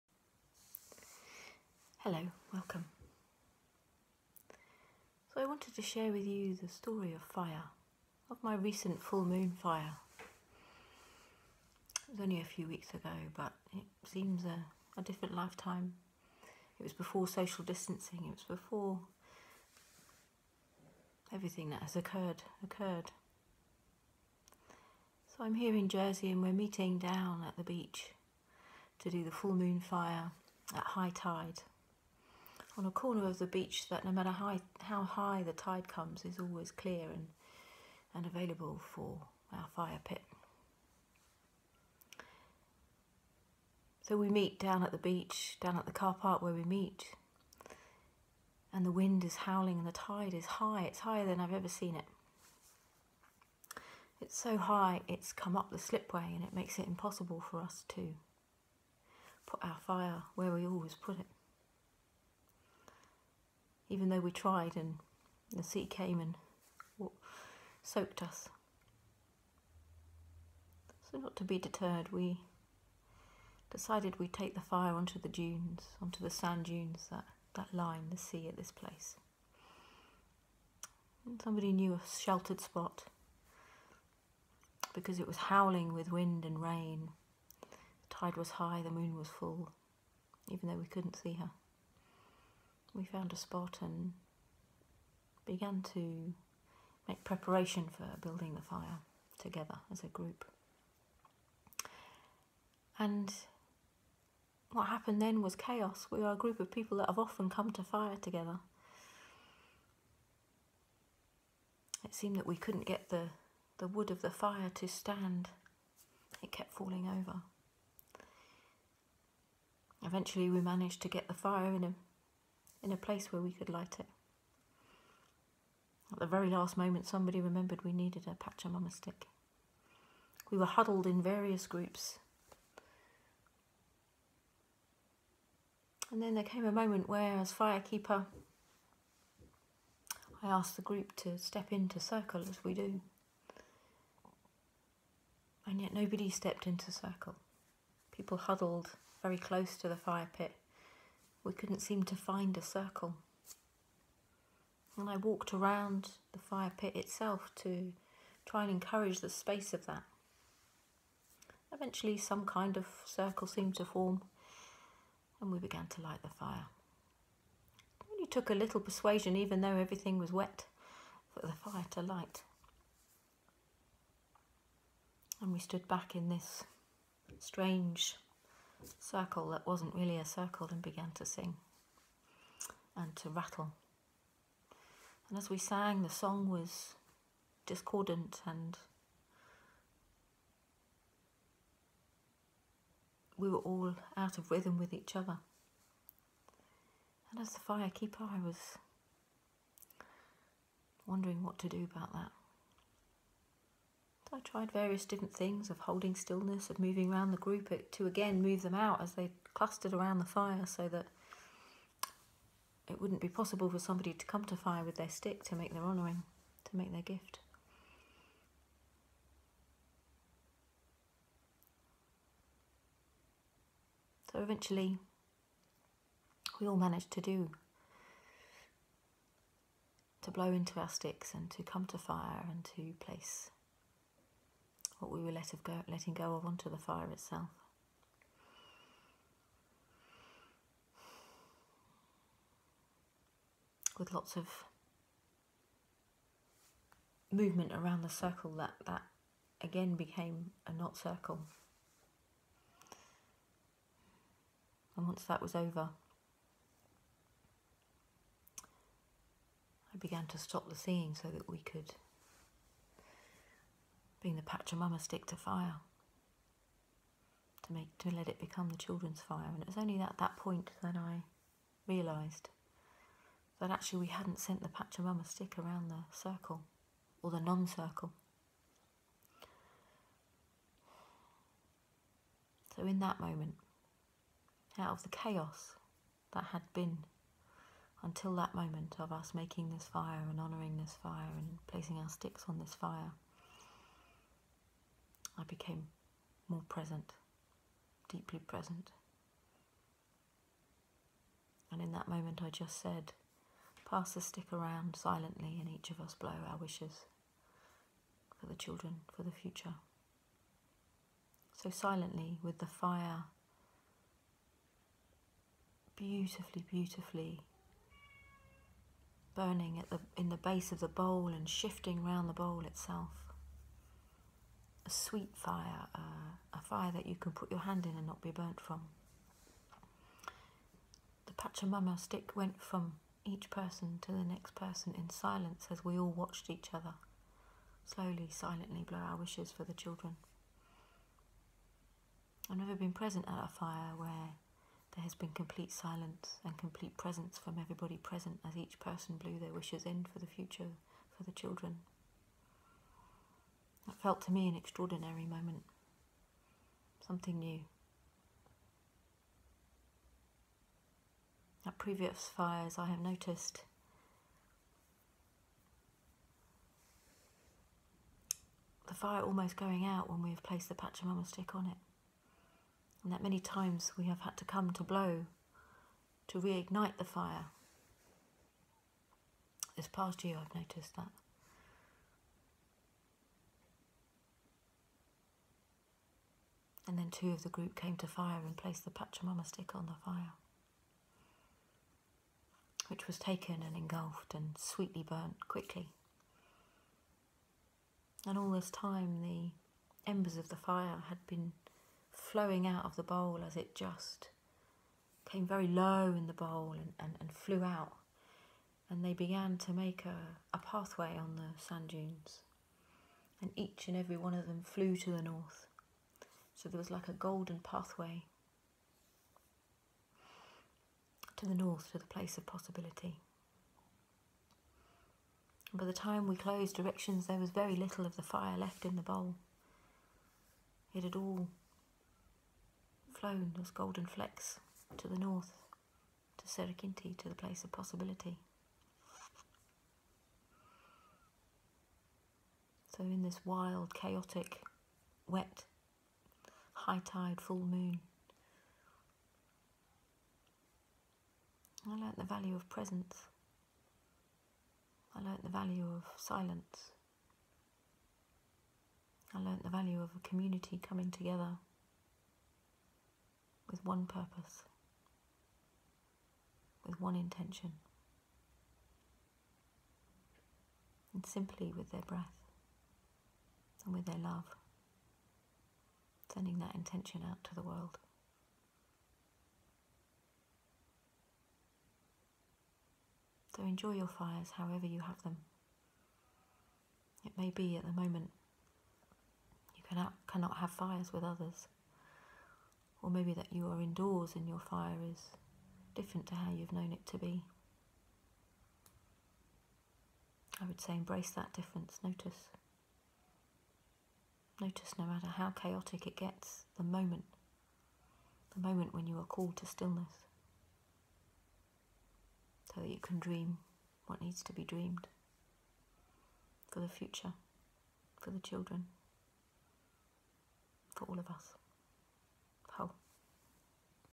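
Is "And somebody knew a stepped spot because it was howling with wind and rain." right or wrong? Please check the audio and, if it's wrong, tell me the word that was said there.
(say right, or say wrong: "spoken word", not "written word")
wrong: "sheltered", not "stepped".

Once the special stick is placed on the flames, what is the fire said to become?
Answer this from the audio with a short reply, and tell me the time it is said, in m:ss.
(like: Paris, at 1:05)
the children's fire, at 4:28.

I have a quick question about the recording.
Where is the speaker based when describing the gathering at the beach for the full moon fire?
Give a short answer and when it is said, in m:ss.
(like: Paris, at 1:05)
Jersey, at 0:25.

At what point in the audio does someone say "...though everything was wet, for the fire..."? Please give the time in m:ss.
2:49.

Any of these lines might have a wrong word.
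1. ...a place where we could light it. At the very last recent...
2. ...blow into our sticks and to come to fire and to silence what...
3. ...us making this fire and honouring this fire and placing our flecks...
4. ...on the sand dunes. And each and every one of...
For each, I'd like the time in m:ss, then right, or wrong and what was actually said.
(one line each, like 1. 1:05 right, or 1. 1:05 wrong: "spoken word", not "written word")
1. 2:02 wrong: "moment", not "recent"
2. 3:50 wrong: "place", not "silence"
3. 4:49 wrong: "sticks", not "flecks"
4. 6:51 right.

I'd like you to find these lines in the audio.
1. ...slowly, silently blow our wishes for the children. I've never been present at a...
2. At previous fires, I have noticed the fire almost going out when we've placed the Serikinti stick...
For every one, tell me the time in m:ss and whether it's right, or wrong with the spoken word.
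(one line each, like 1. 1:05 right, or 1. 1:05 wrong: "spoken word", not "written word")
1. 5:37 right
2. 6:01 wrong: "Pachamama", not "Serikinti".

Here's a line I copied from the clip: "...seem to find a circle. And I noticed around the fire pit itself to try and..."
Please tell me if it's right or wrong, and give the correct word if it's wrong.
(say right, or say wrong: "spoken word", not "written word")
wrong: "walked", not "noticed".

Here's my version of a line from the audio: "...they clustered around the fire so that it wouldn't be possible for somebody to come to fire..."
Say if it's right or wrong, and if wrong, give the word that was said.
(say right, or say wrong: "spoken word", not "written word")
right.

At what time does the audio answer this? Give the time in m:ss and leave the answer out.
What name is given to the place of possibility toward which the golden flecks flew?
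7:16.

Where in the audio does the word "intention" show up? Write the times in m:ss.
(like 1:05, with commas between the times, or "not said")
7:47, 7:56.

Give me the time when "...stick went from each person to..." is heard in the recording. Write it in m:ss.
5:31.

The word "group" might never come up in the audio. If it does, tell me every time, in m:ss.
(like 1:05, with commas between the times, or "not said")
1:40, 1:46, 2:11, 2:20, 3:27, 6:27.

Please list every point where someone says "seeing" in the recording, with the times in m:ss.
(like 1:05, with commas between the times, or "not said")
4:20.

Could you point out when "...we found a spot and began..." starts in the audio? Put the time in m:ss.
1:32.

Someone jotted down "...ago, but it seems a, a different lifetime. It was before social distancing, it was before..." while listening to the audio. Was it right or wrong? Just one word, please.
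right.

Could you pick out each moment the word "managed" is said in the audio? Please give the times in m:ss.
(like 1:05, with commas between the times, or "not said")
2:00, 3:46.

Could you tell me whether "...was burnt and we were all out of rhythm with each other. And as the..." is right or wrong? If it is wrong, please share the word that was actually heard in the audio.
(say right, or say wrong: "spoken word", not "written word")
wrong: "discordant", not "burnt".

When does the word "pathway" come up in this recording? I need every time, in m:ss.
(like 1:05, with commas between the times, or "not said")
6:50, 6:57.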